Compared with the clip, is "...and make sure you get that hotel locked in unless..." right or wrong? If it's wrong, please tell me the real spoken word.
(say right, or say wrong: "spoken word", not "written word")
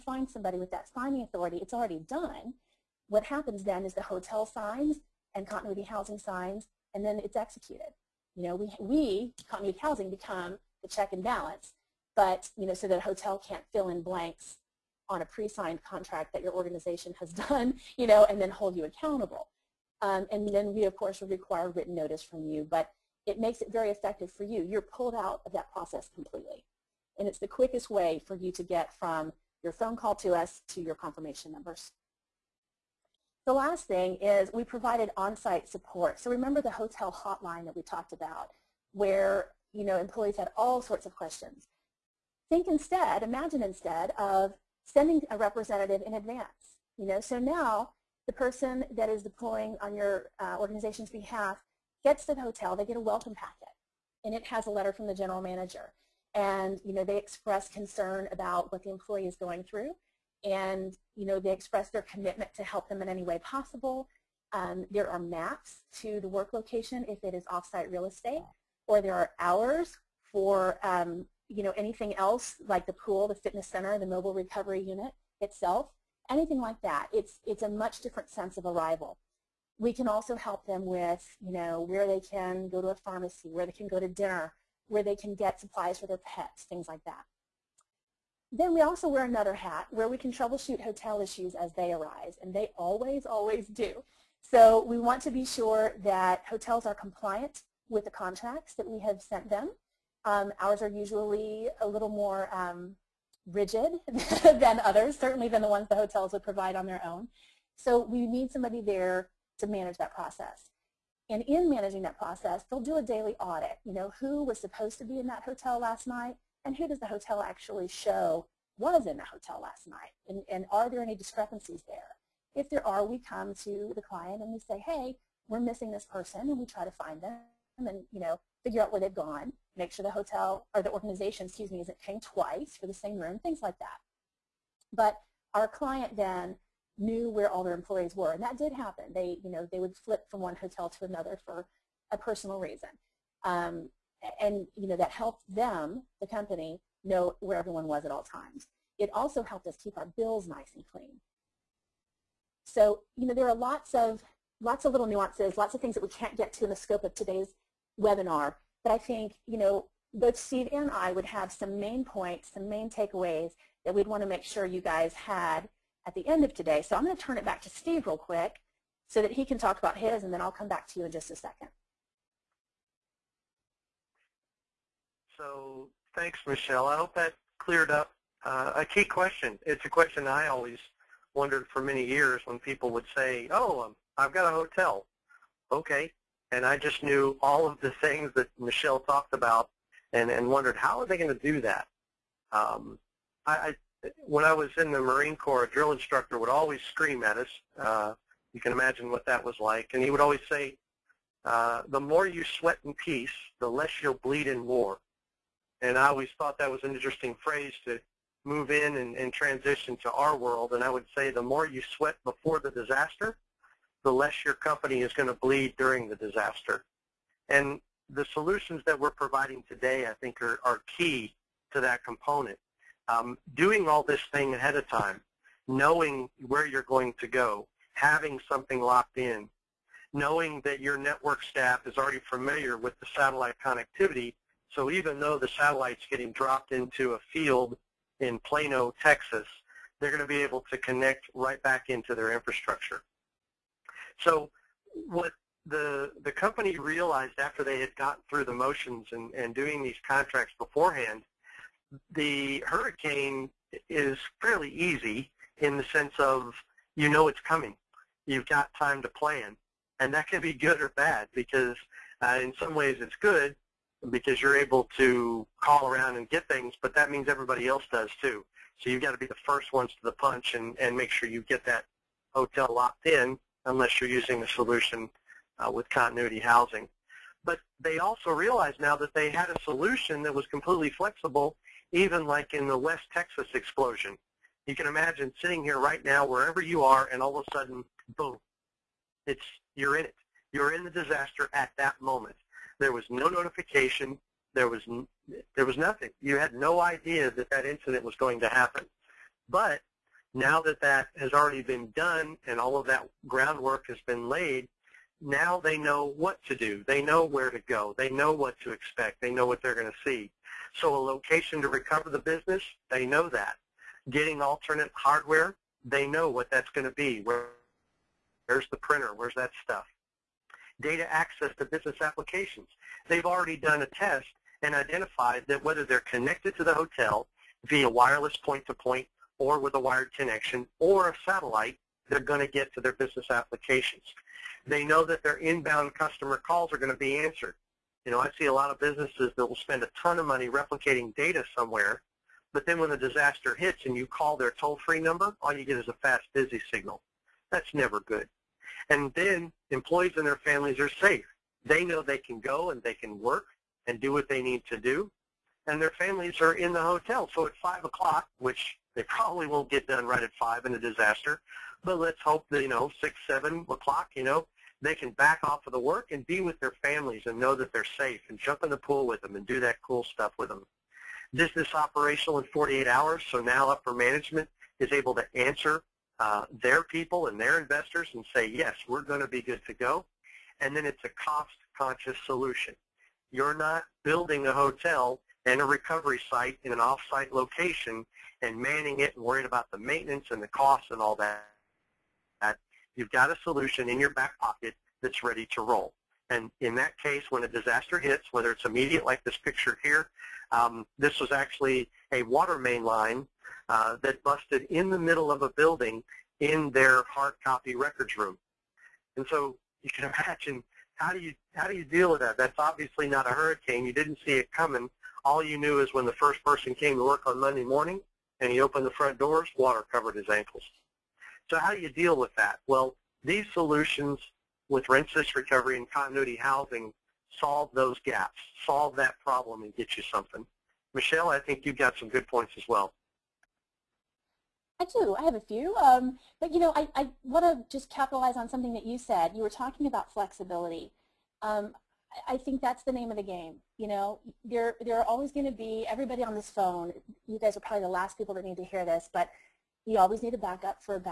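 right.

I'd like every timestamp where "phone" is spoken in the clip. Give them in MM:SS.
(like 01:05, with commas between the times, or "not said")
00:29, 07:26.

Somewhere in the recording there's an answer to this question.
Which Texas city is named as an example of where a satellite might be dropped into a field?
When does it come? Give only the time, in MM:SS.
03:58.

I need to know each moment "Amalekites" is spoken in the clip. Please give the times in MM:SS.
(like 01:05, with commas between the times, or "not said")
not said.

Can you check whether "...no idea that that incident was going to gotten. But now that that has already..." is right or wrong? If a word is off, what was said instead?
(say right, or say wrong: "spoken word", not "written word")
wrong: "happen", not "gotten".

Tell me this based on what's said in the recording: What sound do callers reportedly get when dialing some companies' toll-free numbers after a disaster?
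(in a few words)
Fast busy signal.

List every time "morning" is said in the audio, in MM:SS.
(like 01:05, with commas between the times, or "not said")
06:57.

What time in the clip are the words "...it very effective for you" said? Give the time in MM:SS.
00:23.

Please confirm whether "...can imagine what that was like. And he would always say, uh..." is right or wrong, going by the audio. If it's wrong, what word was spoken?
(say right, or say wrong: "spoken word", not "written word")
right.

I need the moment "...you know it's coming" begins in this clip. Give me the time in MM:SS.
04:16.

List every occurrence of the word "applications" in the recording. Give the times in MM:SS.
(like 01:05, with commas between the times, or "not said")
05:22, 05:33.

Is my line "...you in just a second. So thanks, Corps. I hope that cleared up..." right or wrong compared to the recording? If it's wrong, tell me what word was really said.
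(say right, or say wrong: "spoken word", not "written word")
wrong: "Michelle", not "Corps".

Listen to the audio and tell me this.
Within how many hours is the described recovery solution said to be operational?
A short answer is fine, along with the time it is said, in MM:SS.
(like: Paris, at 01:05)
48, at 06:12.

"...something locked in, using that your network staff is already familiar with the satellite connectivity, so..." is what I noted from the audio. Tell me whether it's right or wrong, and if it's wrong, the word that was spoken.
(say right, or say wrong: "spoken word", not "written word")
wrong: "knowing", not "using".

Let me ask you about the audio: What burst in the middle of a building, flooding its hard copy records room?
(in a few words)
Water main line.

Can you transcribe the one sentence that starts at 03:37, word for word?
And the solutions that we're providing today, I think, are, are key to that component.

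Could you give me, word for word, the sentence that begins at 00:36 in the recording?
So remember the hotel hotline that we talked about where you know employees had all sorts of questions.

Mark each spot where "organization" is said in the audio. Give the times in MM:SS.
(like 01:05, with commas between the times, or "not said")
00:16, 00:50, 02:10.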